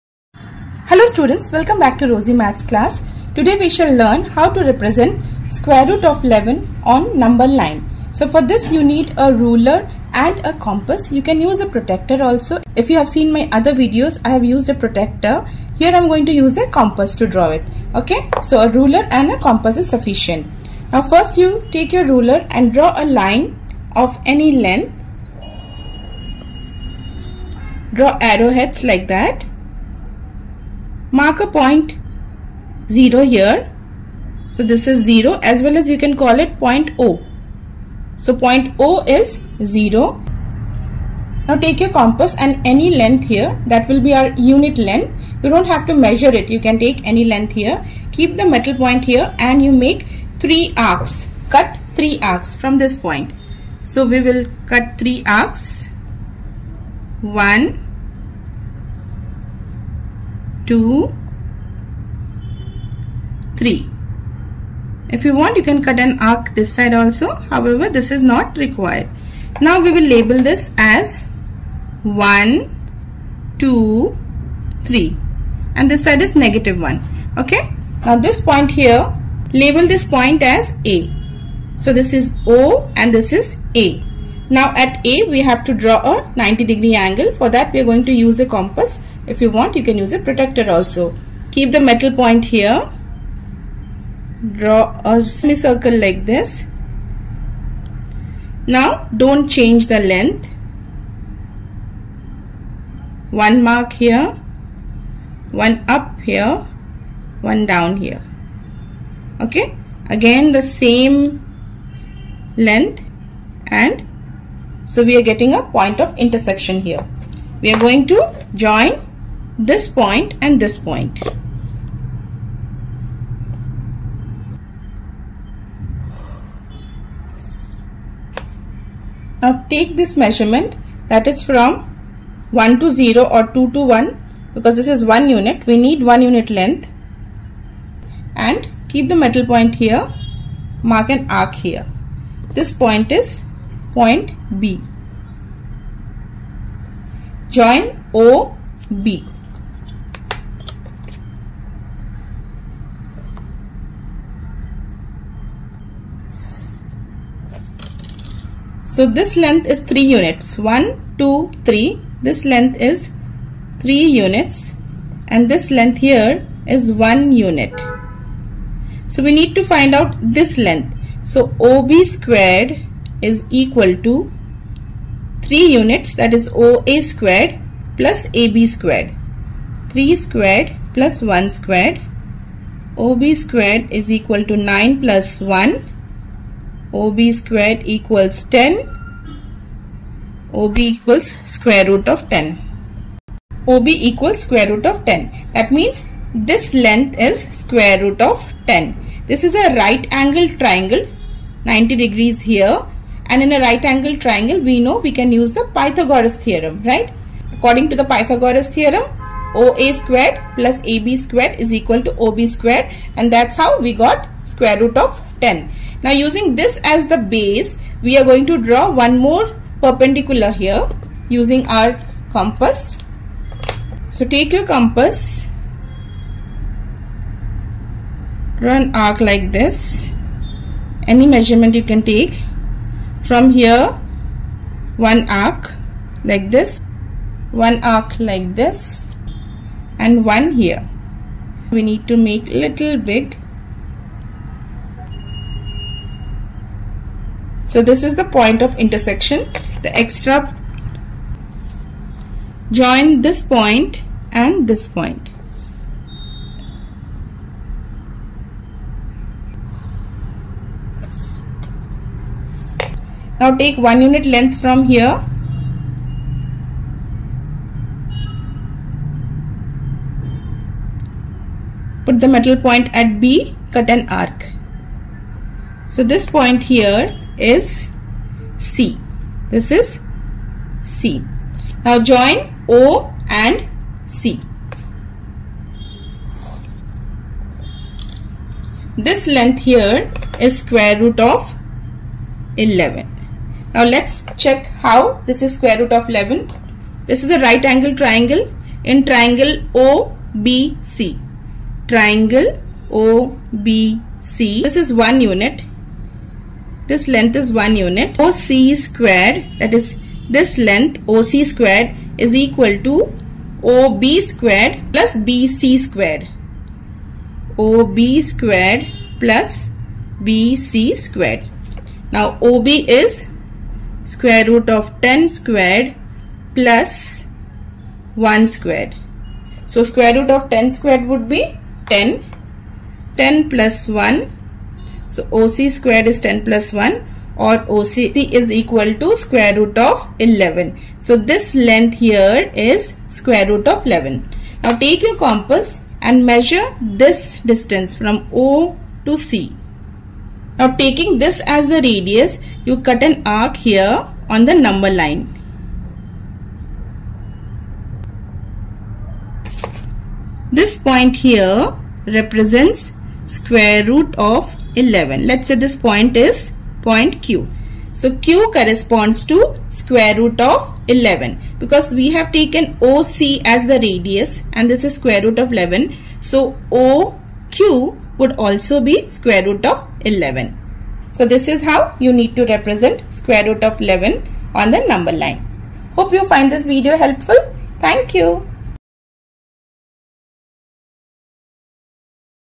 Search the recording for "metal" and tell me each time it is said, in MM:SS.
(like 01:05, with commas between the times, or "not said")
00:48, 01:31, 02:19, 04:32.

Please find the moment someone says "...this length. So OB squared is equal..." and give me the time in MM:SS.
02:50.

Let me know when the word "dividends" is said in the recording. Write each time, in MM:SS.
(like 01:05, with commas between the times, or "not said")
not said.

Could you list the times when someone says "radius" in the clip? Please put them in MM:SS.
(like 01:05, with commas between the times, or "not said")
05:51, 06:13.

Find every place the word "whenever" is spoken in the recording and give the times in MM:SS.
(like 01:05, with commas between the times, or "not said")
not said.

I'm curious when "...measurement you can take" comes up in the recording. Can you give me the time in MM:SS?
03:51.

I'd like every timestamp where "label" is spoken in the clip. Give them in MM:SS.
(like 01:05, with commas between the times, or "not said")
01:10, 01:19.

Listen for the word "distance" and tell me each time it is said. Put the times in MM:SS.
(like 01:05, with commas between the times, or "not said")
05:47.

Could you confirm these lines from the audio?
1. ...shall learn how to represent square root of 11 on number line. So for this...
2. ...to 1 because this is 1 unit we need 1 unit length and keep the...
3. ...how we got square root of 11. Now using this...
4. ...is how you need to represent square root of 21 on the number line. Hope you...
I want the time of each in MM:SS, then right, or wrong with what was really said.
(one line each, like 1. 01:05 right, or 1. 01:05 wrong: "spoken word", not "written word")
1. 00:03 right
2. 02:13 right
3. 03:33 wrong: "10", not "11"
4. 06:21 wrong: "11", not "21".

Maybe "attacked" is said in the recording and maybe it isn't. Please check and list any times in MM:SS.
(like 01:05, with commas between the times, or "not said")
not said.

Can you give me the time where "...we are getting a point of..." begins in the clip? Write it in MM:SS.
01:55.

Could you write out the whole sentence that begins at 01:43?
One mark here, one up here, one down here.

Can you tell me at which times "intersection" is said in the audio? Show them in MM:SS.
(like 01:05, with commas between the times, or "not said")
01:56, 04:08.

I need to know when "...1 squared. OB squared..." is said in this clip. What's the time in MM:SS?
03:01.